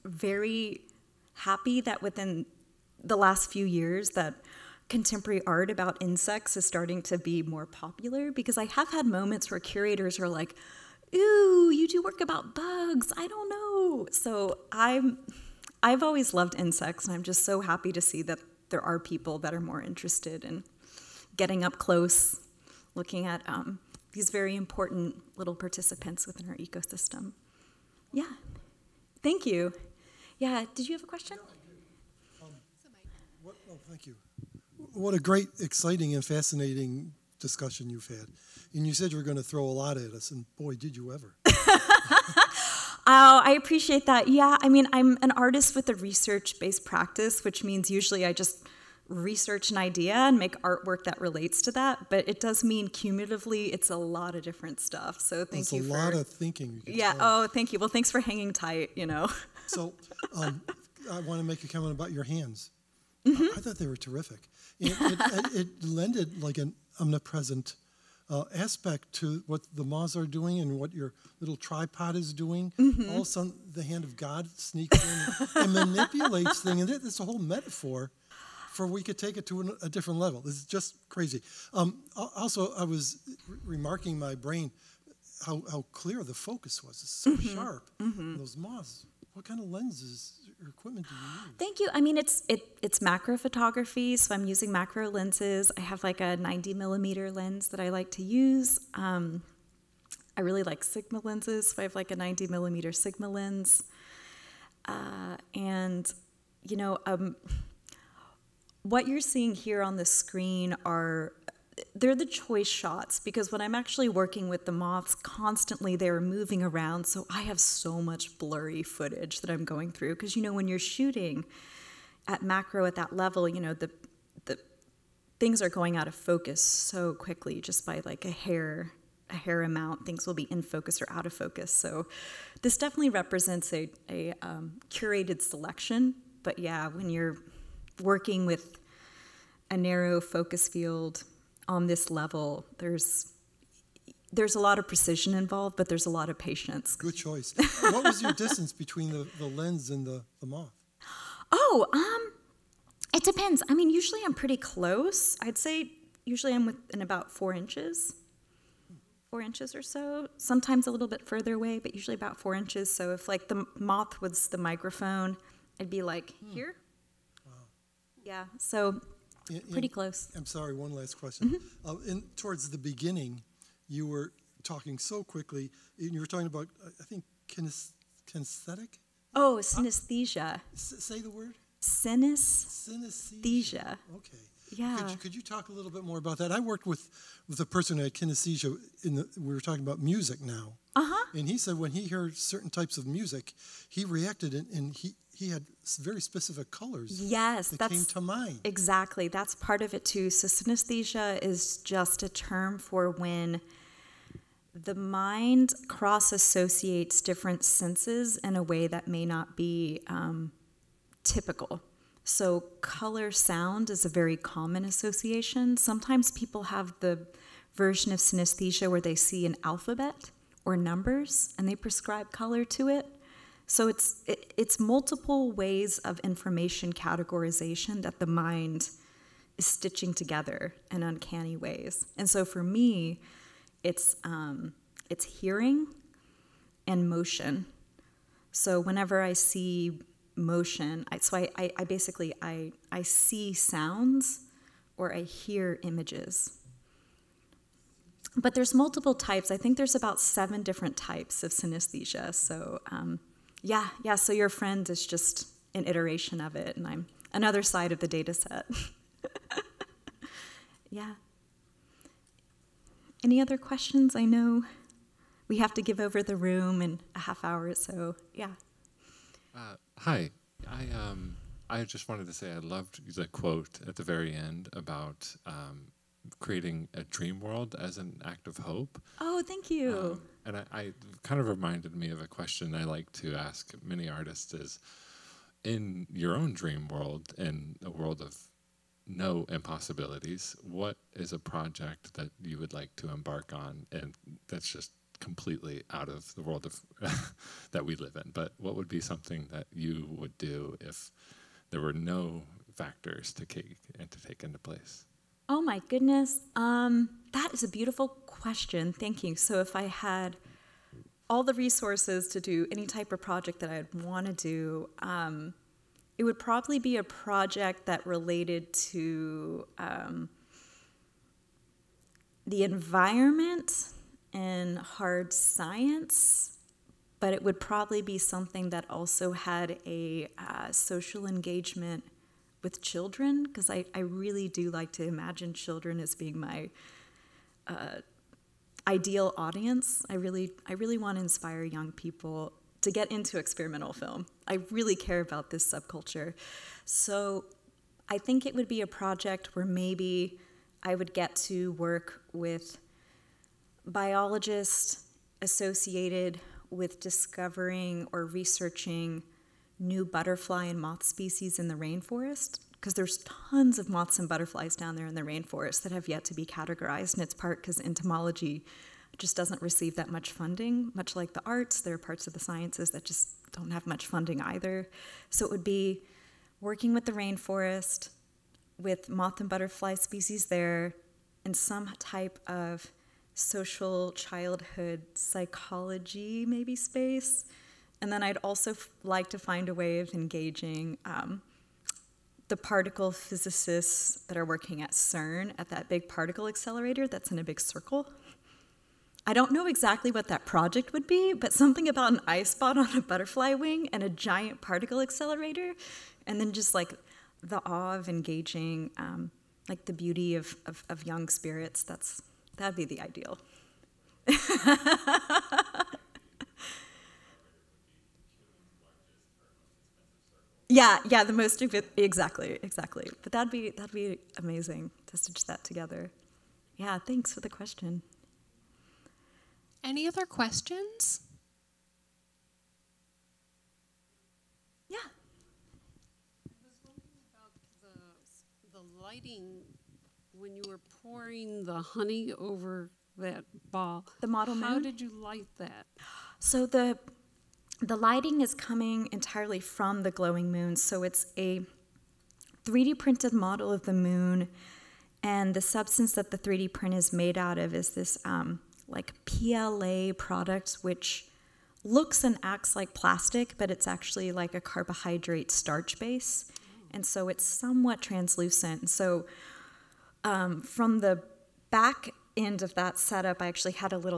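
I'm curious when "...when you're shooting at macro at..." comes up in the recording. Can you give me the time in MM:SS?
02:00.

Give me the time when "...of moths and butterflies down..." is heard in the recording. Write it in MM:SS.
06:03.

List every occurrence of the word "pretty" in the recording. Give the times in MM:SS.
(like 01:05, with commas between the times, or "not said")
02:34, 02:49.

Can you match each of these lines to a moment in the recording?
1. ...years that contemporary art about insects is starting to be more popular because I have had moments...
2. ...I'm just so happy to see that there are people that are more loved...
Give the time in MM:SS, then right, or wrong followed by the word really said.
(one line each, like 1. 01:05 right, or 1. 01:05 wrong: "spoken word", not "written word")
1. 00:03 right
2. 00:17 wrong: "interested", not "loved".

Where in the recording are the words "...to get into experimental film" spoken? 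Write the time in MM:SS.
05:42.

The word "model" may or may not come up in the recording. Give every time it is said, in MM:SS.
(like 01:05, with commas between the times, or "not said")
07:24, 07:33.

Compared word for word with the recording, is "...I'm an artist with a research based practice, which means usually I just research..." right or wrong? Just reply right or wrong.
right.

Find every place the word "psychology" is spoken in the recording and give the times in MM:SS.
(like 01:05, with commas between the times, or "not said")
06:25.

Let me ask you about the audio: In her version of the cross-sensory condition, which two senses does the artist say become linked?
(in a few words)
hearing and motion.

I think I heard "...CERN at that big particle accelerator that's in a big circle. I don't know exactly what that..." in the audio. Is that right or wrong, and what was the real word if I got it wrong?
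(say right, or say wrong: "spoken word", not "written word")
right.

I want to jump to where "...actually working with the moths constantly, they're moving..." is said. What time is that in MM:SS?
01:53.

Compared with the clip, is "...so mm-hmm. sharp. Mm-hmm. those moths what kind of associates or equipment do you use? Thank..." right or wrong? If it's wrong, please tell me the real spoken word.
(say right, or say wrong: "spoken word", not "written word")
wrong: "lenses", not "associates".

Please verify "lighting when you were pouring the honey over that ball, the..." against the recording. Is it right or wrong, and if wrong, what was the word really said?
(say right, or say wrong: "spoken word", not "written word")
right.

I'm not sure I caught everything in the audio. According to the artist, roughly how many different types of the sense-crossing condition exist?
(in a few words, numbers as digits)
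7.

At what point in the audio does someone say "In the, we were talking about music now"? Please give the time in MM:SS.
03:09.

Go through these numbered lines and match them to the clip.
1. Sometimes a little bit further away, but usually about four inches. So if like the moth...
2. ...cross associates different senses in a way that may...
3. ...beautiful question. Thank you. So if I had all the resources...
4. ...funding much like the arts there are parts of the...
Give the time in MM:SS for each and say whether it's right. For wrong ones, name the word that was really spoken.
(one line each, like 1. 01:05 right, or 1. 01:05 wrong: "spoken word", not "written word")
1. 02:40 right
2. 03:25 right
3. 05:07 right
4. 06:10 right.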